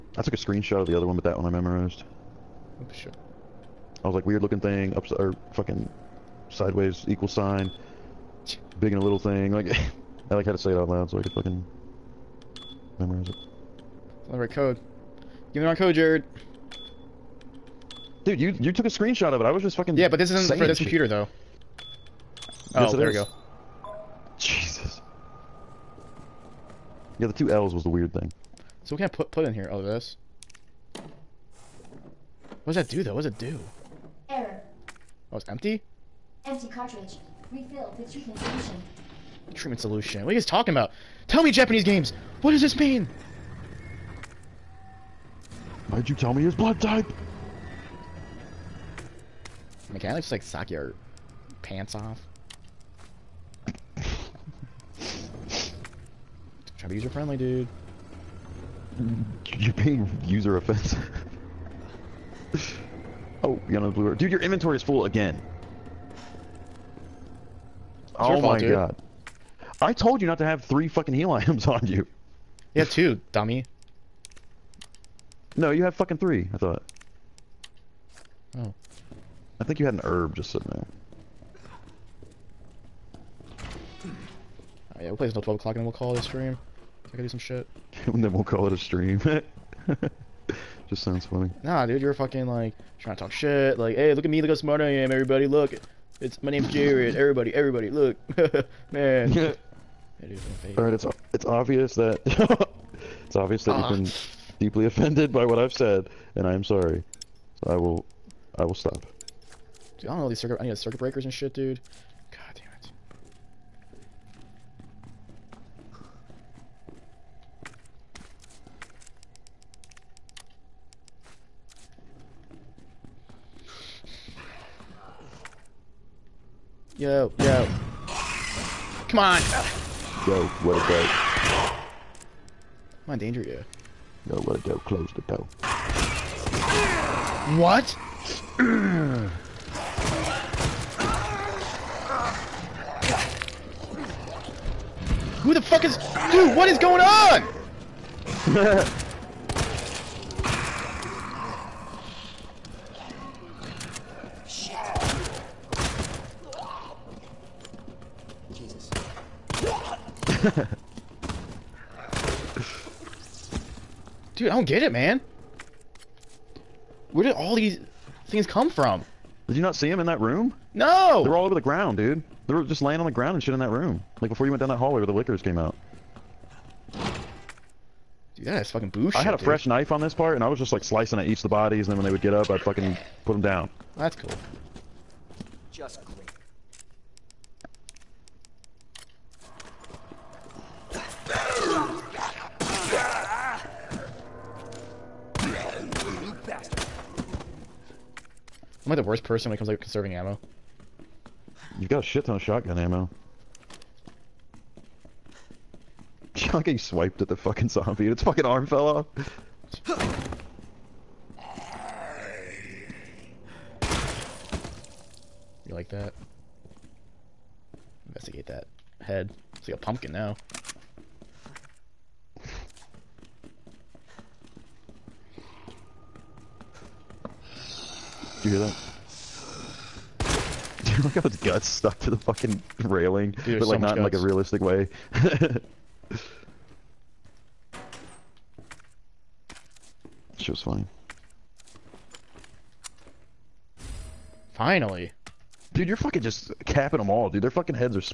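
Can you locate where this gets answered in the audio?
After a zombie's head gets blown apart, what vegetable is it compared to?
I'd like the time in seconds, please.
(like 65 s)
219 s.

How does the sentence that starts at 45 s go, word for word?
did you tell me his blood type?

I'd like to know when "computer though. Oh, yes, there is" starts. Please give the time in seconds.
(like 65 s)
20 s.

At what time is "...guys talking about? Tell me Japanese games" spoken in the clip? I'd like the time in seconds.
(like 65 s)
40 s.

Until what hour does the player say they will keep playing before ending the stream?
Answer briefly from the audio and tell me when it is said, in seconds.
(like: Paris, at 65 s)
12 o'clock, at 85 s.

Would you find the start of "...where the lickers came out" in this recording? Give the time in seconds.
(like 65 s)
175 s.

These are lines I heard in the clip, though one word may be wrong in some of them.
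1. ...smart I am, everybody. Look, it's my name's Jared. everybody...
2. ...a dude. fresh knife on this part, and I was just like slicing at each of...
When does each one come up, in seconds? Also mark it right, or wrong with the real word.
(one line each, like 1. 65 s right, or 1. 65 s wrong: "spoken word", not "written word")
1. 94 s right
2. 179 s right.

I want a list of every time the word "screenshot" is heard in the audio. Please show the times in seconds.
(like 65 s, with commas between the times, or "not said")
0 s, 18 s.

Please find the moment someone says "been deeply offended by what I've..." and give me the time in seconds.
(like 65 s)
103 s.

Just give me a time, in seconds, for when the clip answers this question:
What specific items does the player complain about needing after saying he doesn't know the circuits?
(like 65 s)
110 s.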